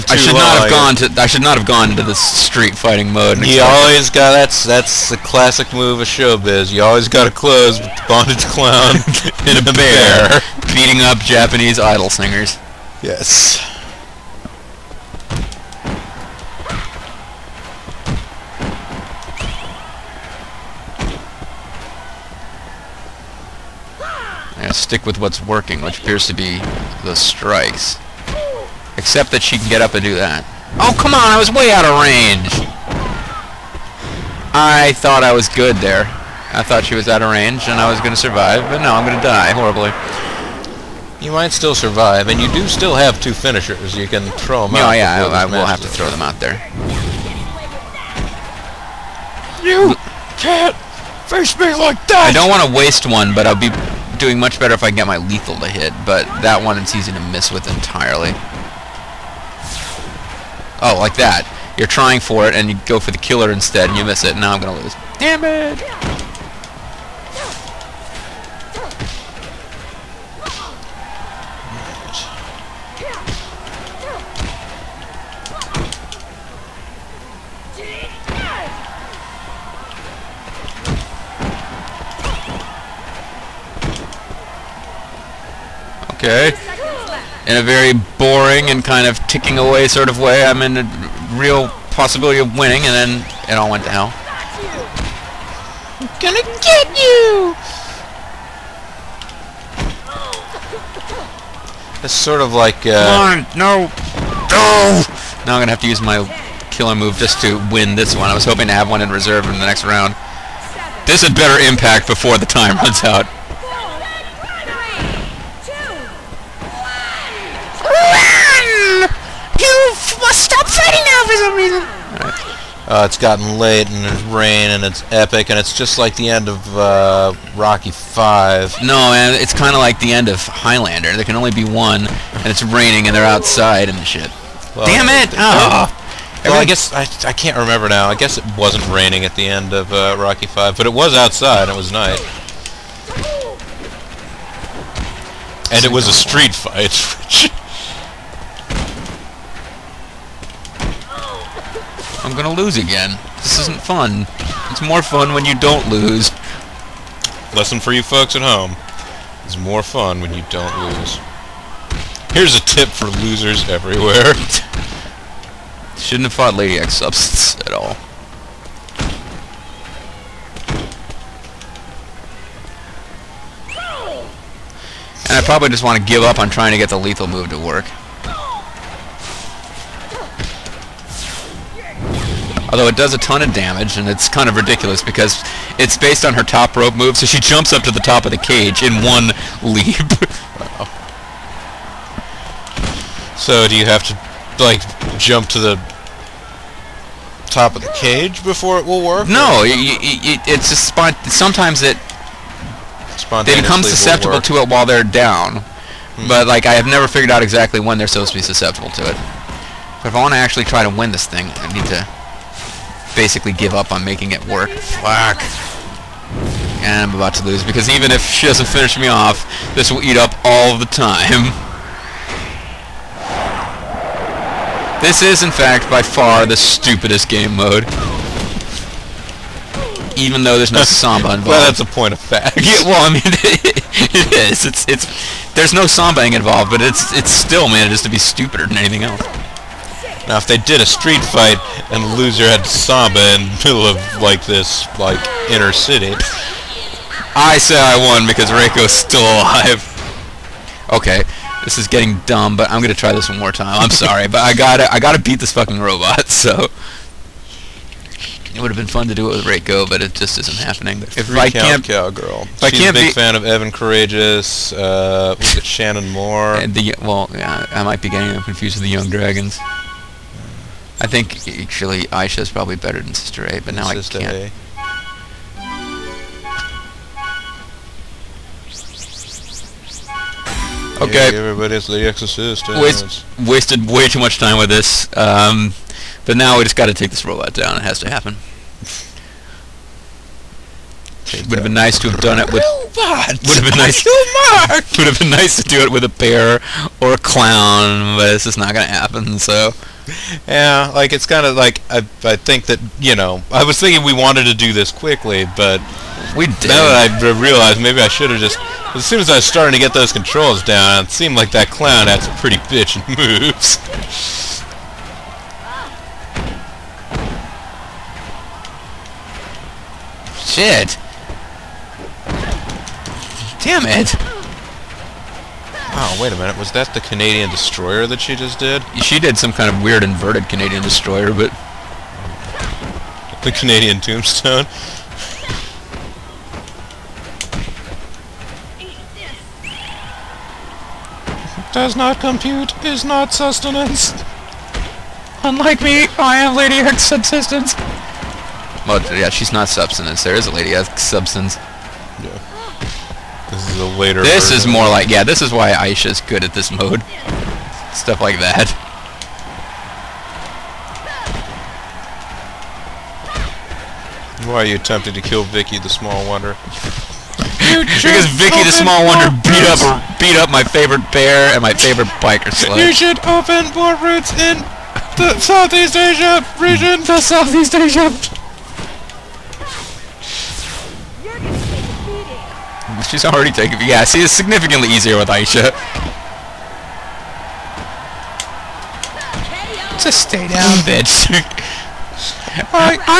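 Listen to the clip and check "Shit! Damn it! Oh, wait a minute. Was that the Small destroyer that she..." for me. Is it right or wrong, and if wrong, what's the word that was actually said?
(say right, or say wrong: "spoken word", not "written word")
wrong: "Canadian", not "Small".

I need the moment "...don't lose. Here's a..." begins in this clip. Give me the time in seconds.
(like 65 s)
160 s.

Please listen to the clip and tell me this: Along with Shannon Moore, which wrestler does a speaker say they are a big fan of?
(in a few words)
Evan Karagias.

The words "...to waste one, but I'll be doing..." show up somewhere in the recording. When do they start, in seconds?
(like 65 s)
52 s.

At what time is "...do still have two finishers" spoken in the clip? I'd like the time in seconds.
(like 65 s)
42 s.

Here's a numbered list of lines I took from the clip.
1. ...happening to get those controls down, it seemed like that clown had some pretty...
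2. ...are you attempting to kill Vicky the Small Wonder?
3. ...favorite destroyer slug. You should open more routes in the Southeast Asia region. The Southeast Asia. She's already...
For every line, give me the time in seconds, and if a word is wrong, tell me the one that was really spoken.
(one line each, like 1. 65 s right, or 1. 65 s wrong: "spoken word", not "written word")
1. 309 s wrong: "starting", not "happening"
2. 364 s right
3. 371 s wrong: "biker", not "destroyer".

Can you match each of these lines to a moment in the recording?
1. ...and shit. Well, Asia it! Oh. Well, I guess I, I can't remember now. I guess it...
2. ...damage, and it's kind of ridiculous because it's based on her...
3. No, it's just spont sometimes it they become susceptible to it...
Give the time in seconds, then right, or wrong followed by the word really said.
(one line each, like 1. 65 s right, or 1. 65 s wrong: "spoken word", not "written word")
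1. 133 s wrong: "Damn", not "Asia"
2. 183 s right
3. 199 s right.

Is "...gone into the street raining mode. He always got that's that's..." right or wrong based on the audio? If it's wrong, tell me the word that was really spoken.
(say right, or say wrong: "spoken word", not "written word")
wrong: "fighting", not "raining".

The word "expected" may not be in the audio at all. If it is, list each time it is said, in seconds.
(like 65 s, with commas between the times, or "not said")
not said.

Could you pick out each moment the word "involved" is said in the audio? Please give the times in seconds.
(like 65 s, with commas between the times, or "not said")
231 s, 236 s.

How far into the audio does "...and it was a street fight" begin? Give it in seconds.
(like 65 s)
145 s.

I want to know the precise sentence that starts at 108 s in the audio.
I was hoping to have one in reserve in the next round.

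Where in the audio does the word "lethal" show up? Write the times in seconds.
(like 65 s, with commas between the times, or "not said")
55 s, 176 s.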